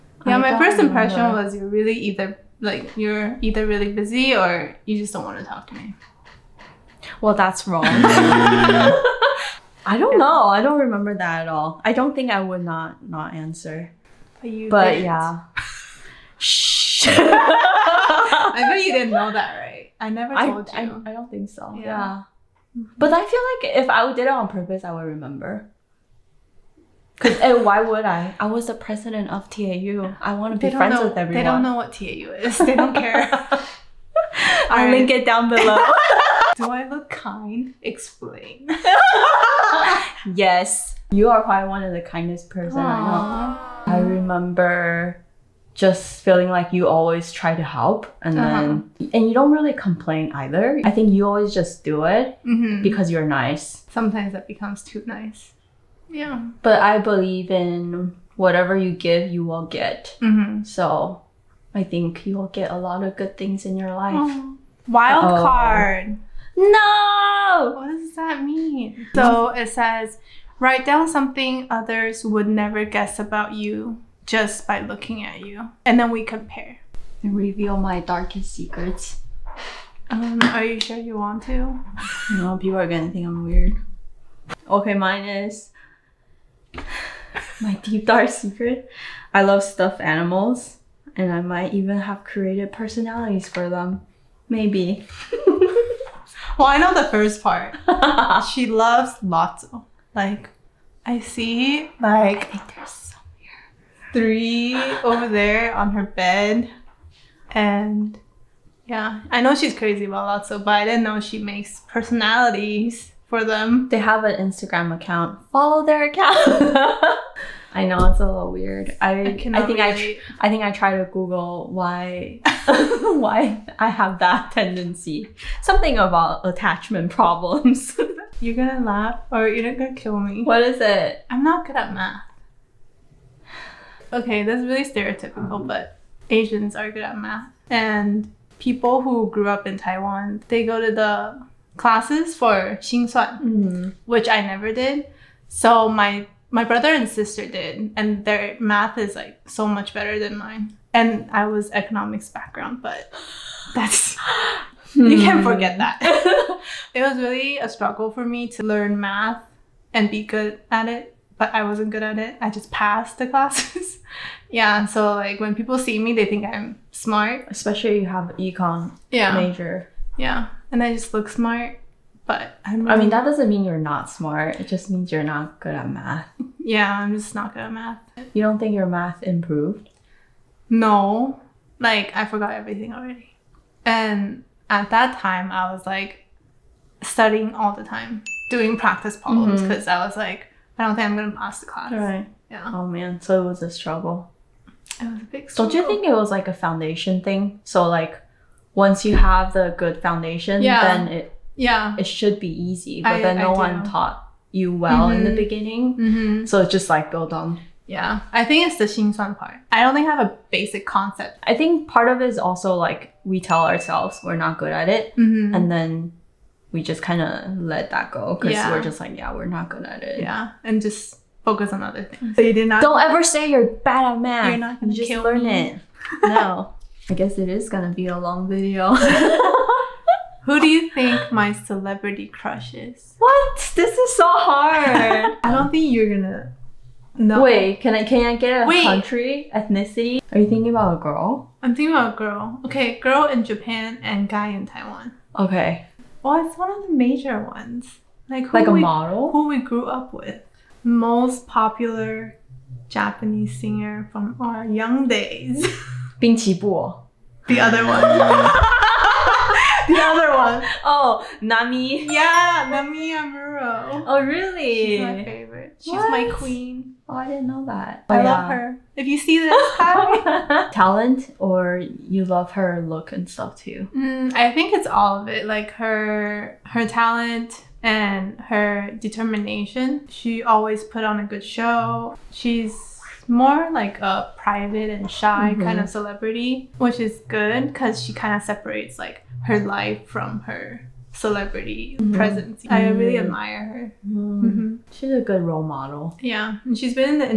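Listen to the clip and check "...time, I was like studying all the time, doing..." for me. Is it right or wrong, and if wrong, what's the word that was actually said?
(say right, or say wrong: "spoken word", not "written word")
right.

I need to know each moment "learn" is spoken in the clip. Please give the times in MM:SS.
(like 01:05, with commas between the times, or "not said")
02:38, 03:45.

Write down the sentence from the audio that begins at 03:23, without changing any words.
But I, then no one taught you well mm-hmm.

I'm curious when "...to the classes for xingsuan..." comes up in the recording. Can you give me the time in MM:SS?
02:20.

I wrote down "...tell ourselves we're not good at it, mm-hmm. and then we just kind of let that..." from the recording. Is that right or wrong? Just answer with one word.
right.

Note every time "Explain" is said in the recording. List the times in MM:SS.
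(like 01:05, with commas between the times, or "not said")
00:37.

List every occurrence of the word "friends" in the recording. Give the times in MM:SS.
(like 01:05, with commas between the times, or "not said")
00:30.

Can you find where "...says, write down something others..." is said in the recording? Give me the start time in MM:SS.
01:09.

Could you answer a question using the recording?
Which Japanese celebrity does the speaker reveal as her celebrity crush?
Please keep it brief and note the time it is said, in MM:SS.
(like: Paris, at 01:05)
Namie Amuro, at 04:22.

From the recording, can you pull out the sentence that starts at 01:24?
Okay, mine is my deep dark secret.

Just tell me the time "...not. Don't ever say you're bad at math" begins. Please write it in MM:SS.
03:42.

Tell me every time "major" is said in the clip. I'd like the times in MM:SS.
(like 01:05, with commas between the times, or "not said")
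02:49, 04:06.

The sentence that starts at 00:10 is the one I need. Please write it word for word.
I don't remember that at all.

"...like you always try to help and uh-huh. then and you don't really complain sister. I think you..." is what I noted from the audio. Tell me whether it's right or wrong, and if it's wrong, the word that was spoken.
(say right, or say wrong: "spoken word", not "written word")
wrong: "either", not "sister".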